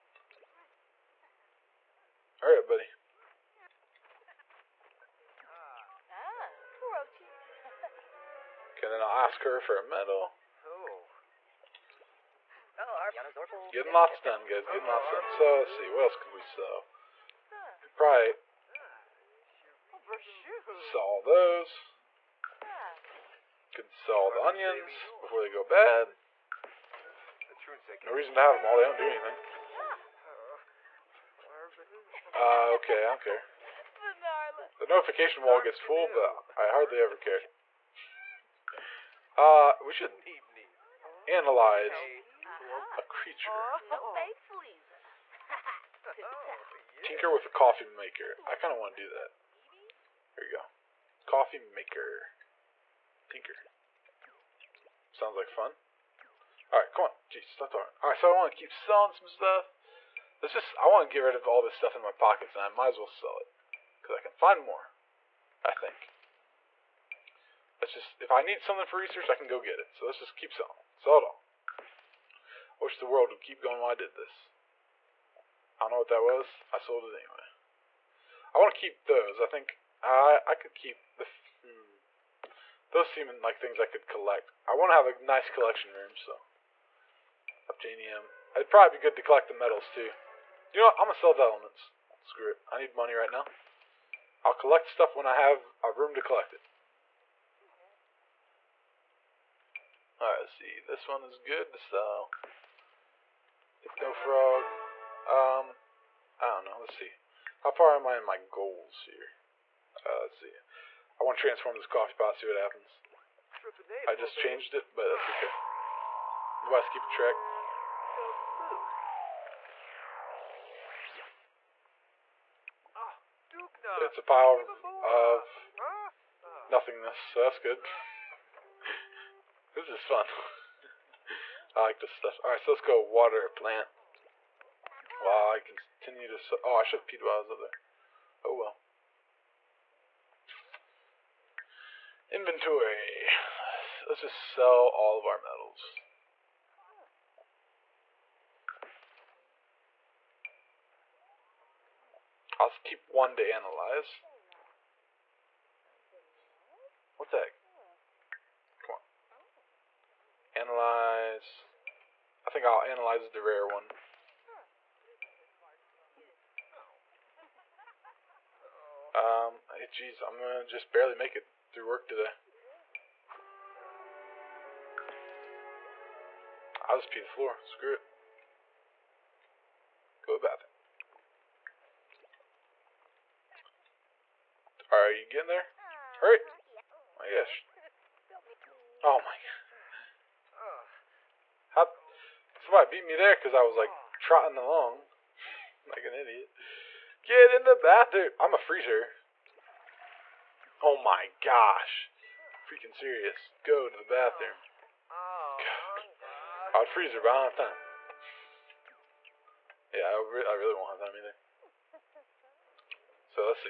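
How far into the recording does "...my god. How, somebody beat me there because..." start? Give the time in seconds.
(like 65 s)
189 s.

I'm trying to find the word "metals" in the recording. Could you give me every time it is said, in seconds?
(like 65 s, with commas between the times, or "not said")
89 s, 145 s.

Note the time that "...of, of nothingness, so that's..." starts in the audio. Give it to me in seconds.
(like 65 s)
124 s.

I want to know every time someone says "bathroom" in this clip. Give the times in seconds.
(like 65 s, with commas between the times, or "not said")
180 s, 197 s, 204 s.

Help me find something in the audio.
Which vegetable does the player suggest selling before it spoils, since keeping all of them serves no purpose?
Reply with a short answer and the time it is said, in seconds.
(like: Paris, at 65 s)
Onions, at 24 s.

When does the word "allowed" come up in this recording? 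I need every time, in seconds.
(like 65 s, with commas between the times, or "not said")
not said.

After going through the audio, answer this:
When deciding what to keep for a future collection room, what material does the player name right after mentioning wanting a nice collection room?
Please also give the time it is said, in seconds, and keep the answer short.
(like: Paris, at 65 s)
Obtainium, at 87 s.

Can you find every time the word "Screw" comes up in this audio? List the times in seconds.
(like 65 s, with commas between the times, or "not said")
92 s, 177 s.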